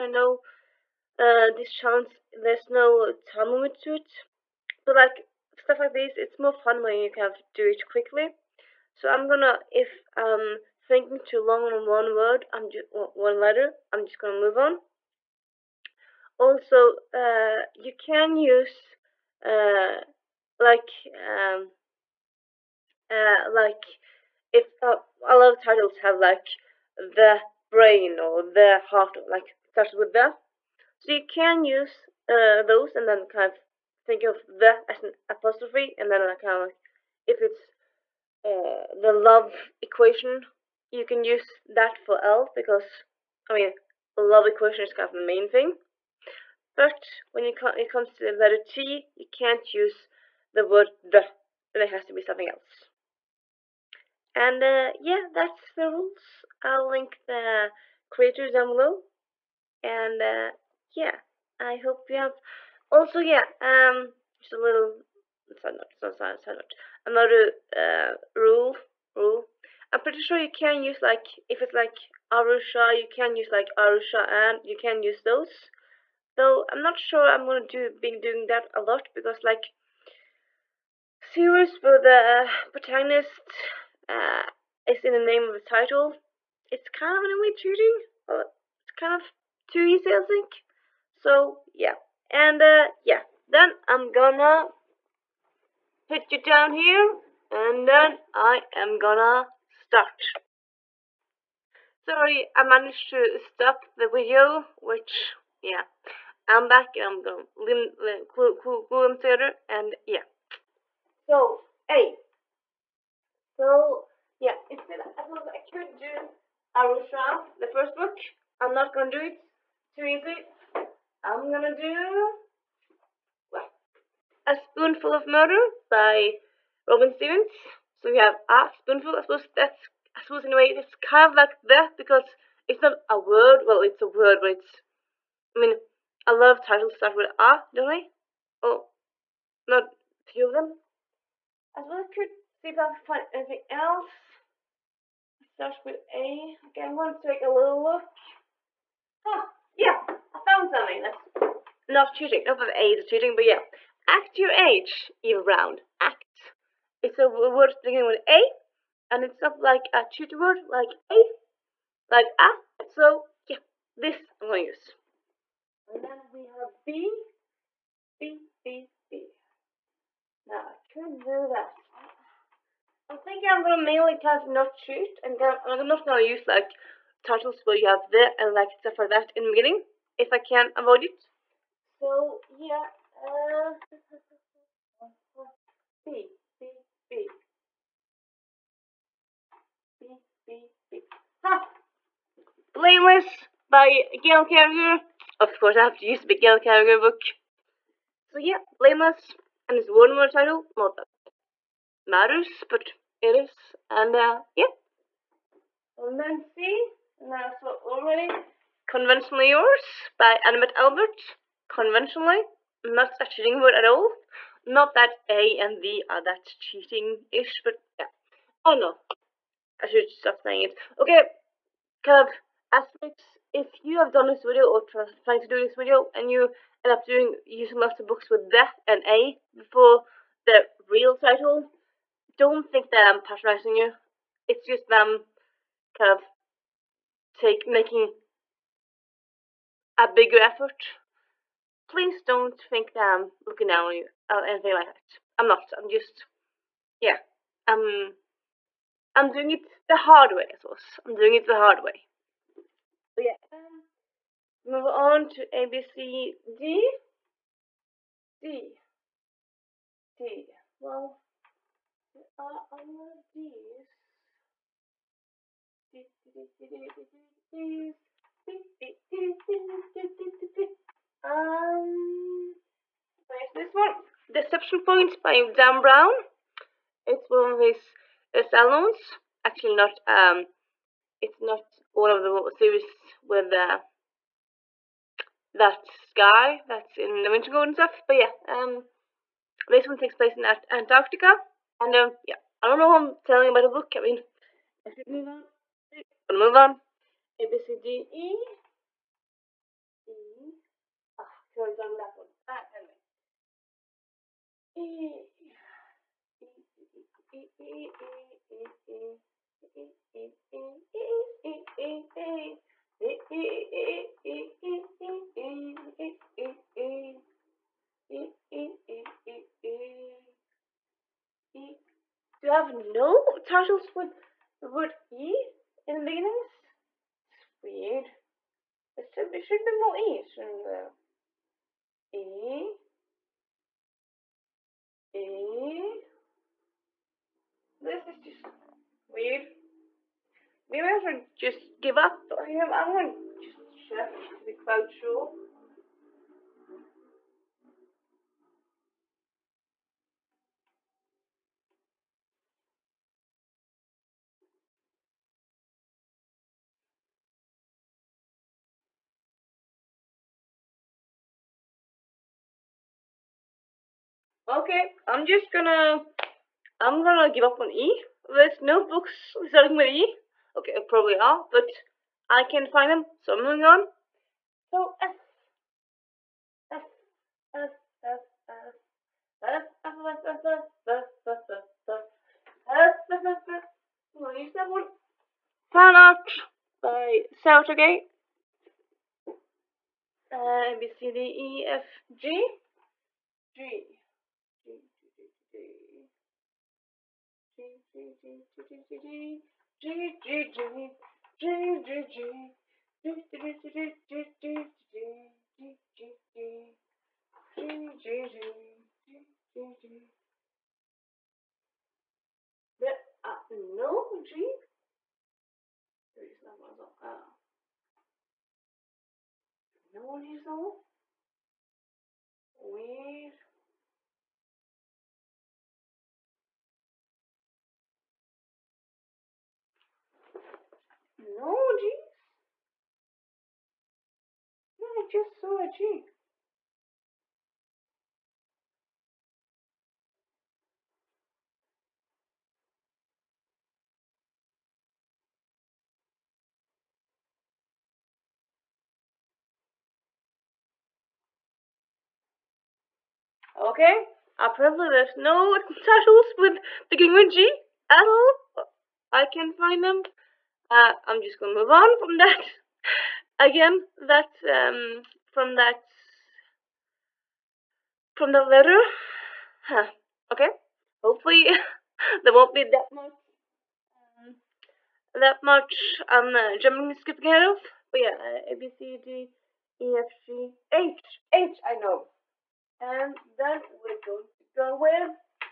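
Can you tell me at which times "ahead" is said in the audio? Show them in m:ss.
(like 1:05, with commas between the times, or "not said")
7:57.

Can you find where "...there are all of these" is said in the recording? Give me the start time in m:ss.
4:22.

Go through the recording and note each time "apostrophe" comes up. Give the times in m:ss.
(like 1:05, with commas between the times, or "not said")
0:35.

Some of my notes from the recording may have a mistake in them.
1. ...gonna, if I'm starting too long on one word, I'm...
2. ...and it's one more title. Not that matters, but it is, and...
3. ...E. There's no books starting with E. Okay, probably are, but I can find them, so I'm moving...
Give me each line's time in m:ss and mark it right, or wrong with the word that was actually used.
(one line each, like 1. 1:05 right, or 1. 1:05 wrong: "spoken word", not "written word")
1. 0:09 wrong: "thinking", not "starting"
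2. 3:19 right
3. 6:07 right.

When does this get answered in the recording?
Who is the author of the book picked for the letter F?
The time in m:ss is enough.
6:27.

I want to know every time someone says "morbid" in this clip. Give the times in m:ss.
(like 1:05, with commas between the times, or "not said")
not said.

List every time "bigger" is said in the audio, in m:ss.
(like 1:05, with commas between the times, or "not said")
4:00.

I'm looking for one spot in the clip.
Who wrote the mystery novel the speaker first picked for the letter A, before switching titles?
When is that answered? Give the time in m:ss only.
2:06.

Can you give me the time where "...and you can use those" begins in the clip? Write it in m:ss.
1:14.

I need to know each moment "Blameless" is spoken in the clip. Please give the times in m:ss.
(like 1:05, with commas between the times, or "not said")
3:12, 3:18.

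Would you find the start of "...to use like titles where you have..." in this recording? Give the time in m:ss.
2:56.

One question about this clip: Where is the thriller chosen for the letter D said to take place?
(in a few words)
Antarctica.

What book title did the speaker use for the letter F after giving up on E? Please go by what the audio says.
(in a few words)
Fan Art.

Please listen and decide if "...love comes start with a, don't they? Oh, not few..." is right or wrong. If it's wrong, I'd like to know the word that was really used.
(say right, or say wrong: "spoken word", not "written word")
wrong: "titles", not "comes".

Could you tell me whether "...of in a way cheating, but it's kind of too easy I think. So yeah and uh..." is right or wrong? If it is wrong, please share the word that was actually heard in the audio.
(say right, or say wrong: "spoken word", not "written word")
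right.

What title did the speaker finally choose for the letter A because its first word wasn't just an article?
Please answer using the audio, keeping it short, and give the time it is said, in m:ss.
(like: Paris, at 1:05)
Act Your Age, Eve Brown, at 2:34.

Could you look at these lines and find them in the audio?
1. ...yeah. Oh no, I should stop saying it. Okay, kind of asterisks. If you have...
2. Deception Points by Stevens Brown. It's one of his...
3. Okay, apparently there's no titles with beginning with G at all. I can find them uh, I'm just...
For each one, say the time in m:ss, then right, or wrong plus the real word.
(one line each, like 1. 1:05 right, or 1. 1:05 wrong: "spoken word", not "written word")
1. 3:37 right
2. 4:34 wrong: "Dan", not "Stevens"
3. 7:33 right.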